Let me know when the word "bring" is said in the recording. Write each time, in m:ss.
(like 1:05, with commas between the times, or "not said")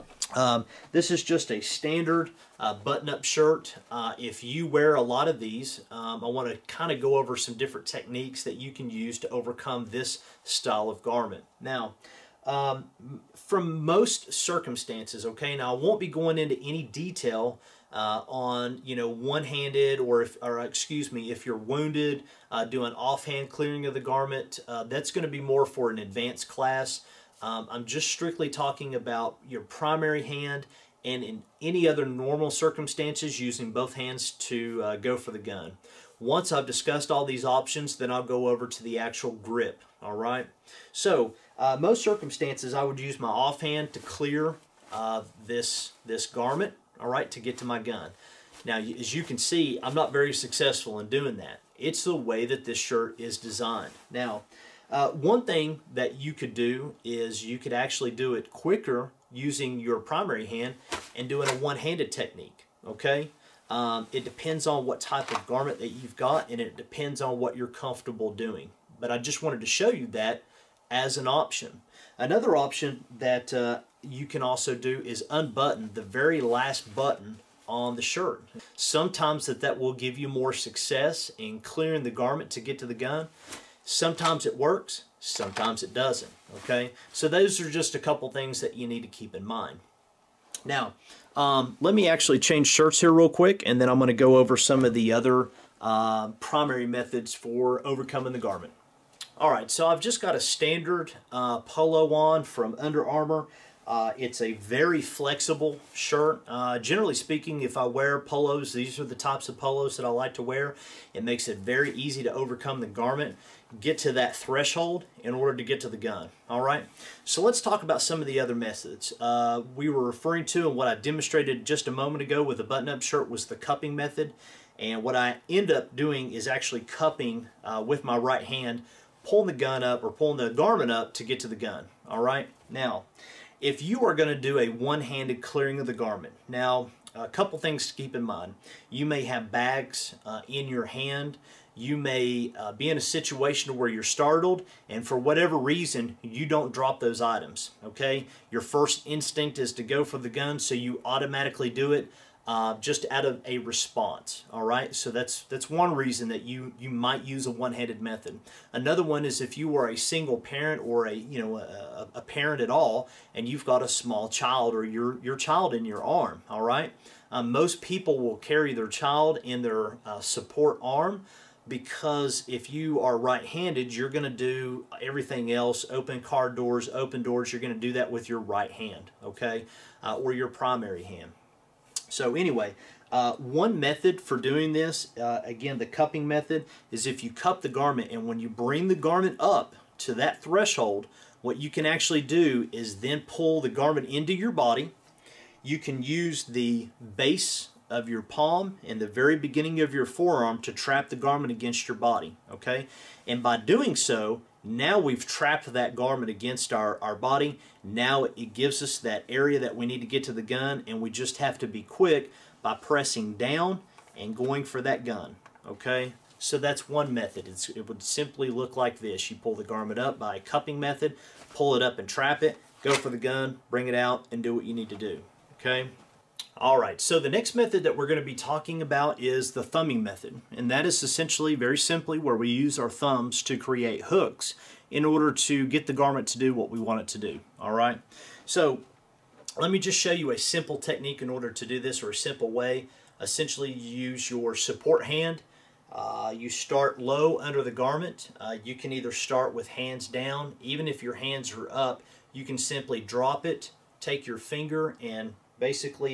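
3:08, 3:43.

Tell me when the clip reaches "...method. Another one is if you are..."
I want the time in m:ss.
2:37.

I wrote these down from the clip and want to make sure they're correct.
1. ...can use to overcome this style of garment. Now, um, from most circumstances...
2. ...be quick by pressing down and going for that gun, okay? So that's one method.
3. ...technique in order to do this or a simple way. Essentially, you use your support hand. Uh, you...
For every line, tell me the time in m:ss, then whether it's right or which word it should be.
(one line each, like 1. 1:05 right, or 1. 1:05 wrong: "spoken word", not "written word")
1. 0:08 right
2. 3:31 right
3. 4:00 right.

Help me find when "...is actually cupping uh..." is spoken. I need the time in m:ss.
2:06.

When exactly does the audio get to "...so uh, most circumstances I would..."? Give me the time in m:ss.
0:40.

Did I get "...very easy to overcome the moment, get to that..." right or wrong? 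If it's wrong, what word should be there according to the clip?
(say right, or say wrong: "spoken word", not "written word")
wrong: "garment", not "moment".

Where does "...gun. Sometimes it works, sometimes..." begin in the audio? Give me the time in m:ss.
1:22.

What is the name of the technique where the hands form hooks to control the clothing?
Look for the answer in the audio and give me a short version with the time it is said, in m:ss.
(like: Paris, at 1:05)
thumbing method, at 3:49.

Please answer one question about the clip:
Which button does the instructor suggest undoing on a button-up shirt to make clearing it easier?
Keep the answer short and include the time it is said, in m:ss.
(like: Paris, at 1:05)
the very last button, at 1:16.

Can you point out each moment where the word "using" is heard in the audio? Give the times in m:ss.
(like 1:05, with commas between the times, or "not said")
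0:33, 0:59.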